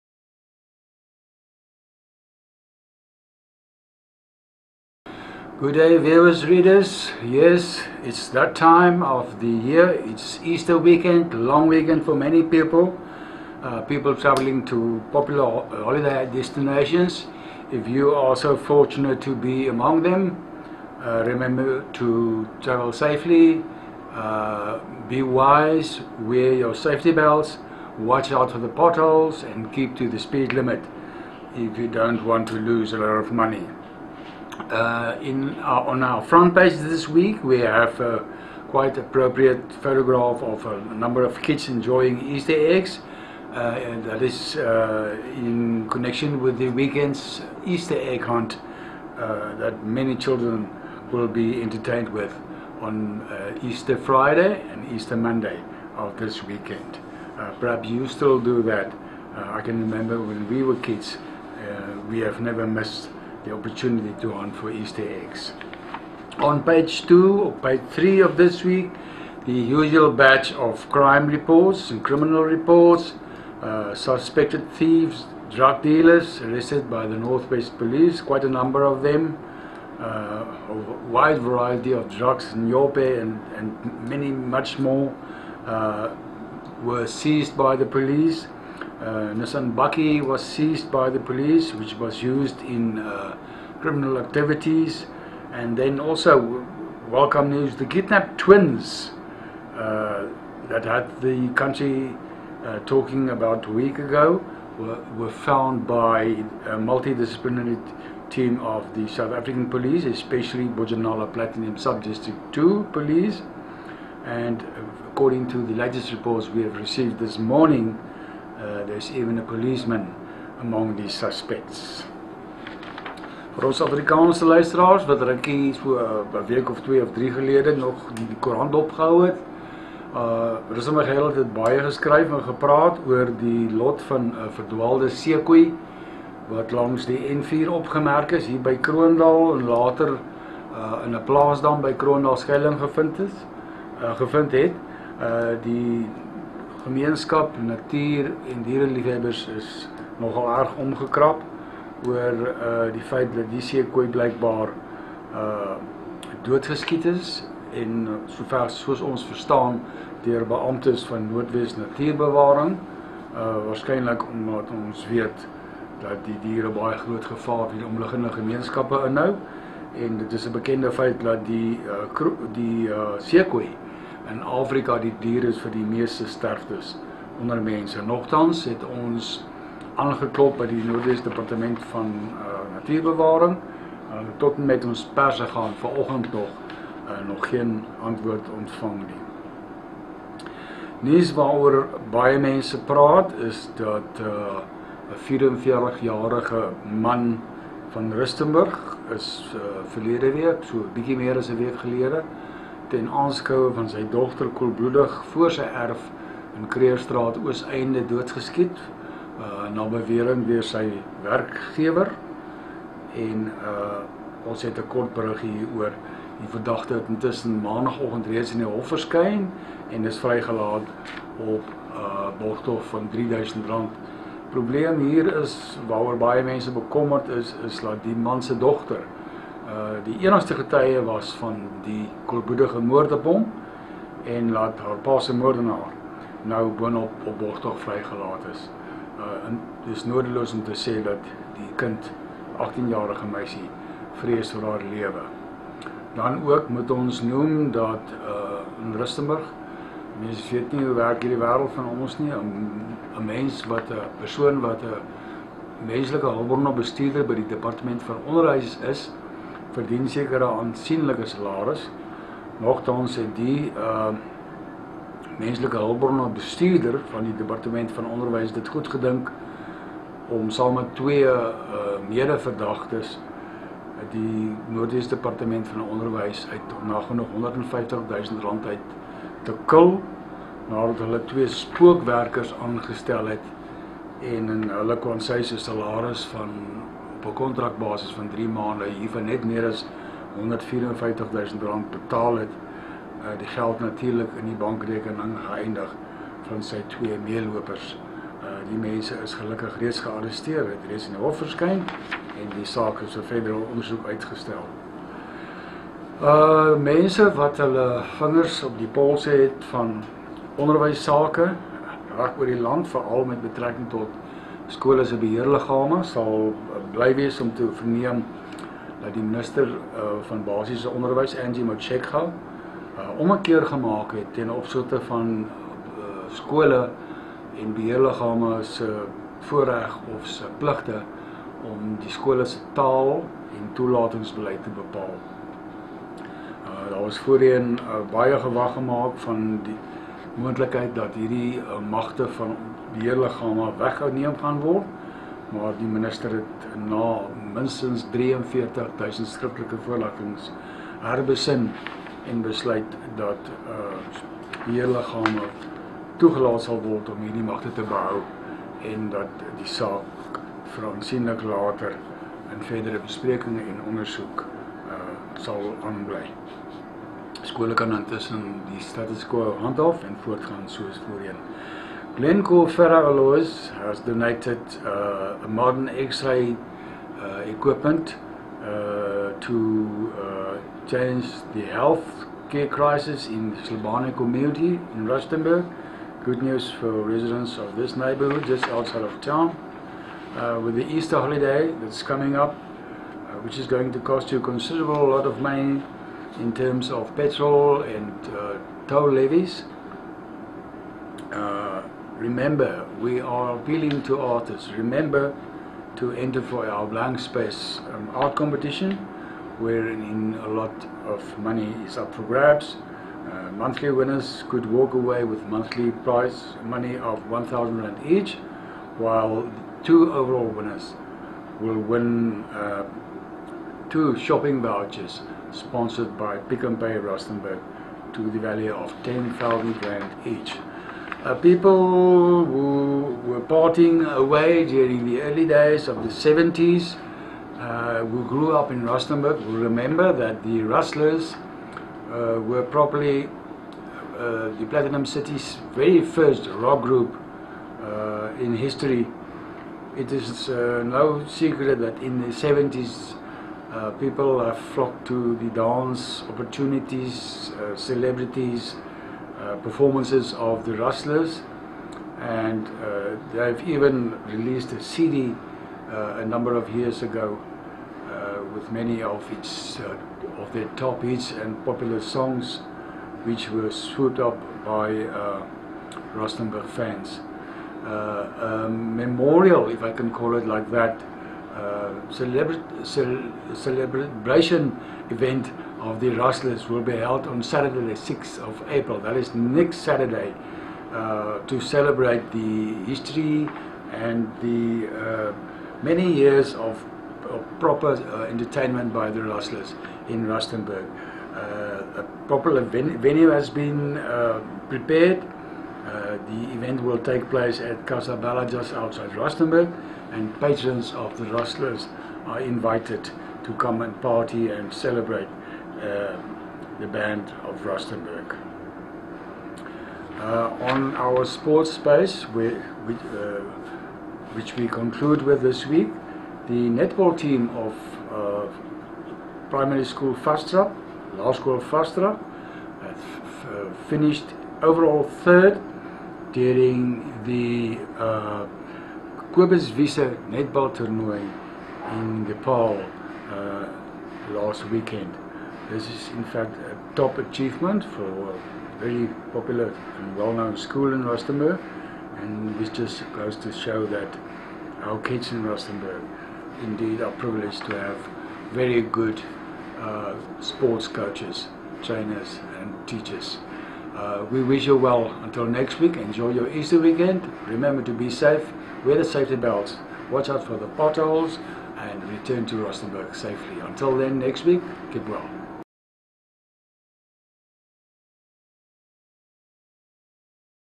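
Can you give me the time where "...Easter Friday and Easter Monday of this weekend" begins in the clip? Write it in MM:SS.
00:53.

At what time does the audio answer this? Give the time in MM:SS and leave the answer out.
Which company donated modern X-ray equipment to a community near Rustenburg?
06:12.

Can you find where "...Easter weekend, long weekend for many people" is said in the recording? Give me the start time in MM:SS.
00:10.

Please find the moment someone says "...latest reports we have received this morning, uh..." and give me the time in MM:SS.
01:55.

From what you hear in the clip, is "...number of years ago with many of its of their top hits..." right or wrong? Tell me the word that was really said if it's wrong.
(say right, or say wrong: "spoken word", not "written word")
right.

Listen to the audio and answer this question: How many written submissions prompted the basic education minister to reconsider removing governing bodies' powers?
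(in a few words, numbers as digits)
43000.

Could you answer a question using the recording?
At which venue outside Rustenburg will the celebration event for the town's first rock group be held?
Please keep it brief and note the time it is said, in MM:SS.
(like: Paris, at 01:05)
Casa Bella, at 08:27.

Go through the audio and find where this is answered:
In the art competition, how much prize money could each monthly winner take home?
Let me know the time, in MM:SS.
06:57.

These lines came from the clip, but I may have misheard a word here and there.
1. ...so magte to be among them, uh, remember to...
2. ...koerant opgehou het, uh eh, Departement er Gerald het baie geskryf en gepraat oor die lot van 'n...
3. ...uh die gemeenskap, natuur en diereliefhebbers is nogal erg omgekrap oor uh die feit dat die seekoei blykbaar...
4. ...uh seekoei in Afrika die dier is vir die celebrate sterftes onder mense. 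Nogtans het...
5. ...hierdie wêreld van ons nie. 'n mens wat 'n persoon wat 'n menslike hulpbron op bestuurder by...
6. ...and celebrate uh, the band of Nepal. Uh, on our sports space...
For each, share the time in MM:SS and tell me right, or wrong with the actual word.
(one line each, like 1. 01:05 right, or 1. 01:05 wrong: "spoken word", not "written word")
1. 00:18 wrong: "fortunate", not "magte"
2. 02:08 wrong: "Rusom", not "Departement"
3. 02:25 right
4. 02:52 wrong: "meeste", not "celebrate"
5. 04:11 right
6. 08:34 wrong: "Rustenburg", not "Nepal".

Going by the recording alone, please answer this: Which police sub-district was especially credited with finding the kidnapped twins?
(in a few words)
Bojanala Platinum Sub-District 2.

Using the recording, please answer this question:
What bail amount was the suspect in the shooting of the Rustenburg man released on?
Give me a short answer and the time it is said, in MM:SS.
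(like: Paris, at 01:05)
R3000, at 03:43.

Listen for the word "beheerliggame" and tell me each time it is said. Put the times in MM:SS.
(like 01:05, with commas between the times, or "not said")
05:15, 05:27.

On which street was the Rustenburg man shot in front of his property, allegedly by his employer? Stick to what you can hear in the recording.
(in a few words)
Kreerstraat.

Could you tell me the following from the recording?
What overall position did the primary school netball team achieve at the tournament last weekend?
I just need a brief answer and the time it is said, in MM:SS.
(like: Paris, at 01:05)
third, at 08:55.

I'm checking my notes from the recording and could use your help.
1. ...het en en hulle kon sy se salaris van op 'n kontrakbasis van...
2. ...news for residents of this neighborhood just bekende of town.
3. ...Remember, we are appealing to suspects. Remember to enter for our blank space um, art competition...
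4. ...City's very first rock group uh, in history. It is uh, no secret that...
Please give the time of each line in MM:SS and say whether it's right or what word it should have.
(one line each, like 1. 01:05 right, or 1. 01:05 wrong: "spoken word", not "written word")
1. 04:43 right
2. 06:26 wrong: "outside", not "bekende"
3. 06:42 wrong: "artists", not "suspects"
4. 07:25 right.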